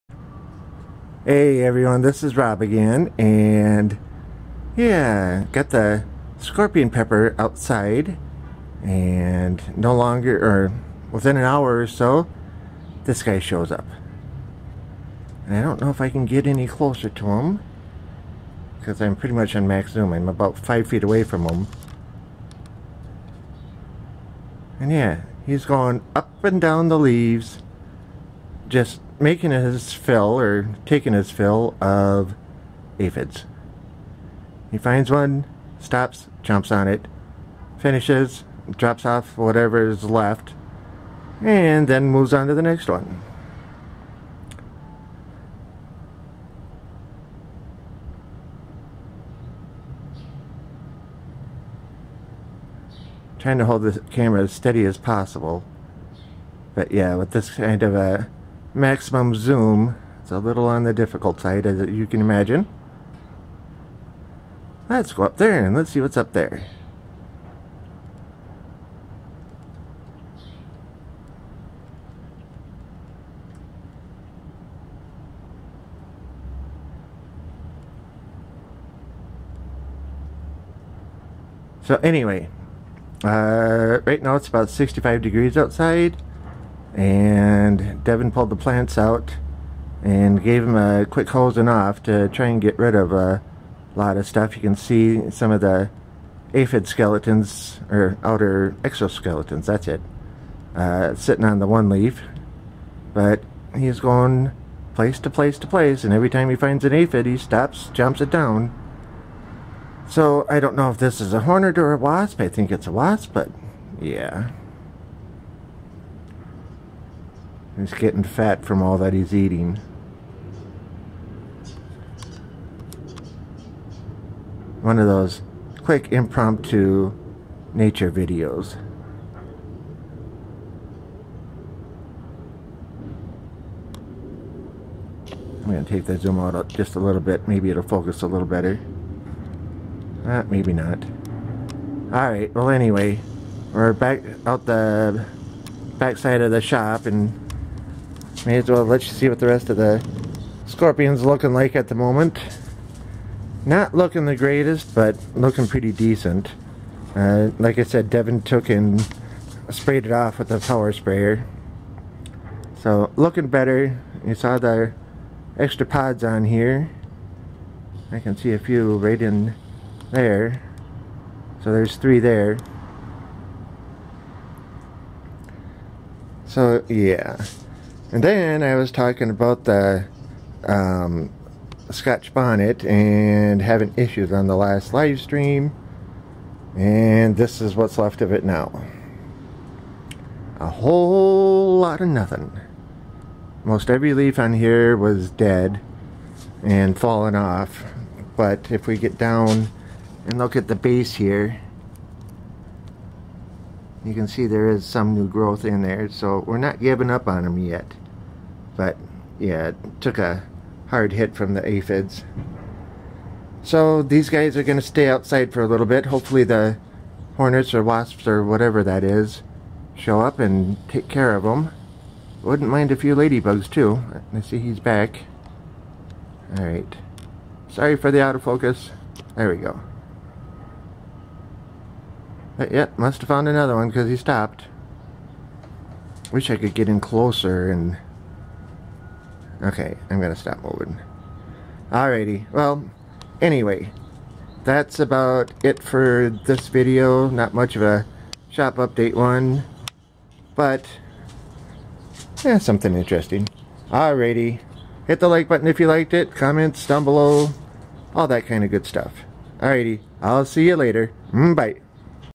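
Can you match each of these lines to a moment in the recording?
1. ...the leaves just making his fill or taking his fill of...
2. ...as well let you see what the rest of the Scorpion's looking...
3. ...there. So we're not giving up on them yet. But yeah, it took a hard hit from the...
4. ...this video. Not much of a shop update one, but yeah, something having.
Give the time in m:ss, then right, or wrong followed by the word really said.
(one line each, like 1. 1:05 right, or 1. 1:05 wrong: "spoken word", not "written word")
1. 0:26 right
2. 2:28 right
3. 3:25 right
4. 4:06 wrong: "interesting", not "having".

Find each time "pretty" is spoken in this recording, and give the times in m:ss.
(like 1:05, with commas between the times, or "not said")
0:19, 2:35.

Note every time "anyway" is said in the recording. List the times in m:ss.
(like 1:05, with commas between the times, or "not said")
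1:22, 2:22, 4:03.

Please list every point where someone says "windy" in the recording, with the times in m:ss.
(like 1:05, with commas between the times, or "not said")
not said.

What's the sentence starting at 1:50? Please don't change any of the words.
So I don't know if this is a hornet or a wasp.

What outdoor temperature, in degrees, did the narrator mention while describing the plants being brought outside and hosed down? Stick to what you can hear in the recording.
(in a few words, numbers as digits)
65 degrees.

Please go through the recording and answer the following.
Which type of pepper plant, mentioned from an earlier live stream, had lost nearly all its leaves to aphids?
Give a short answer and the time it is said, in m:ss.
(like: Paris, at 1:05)
Scotch bonnet, at 3:01.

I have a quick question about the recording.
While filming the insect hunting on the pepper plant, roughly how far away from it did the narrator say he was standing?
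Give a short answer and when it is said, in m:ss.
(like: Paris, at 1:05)
5 feet, at 0:20.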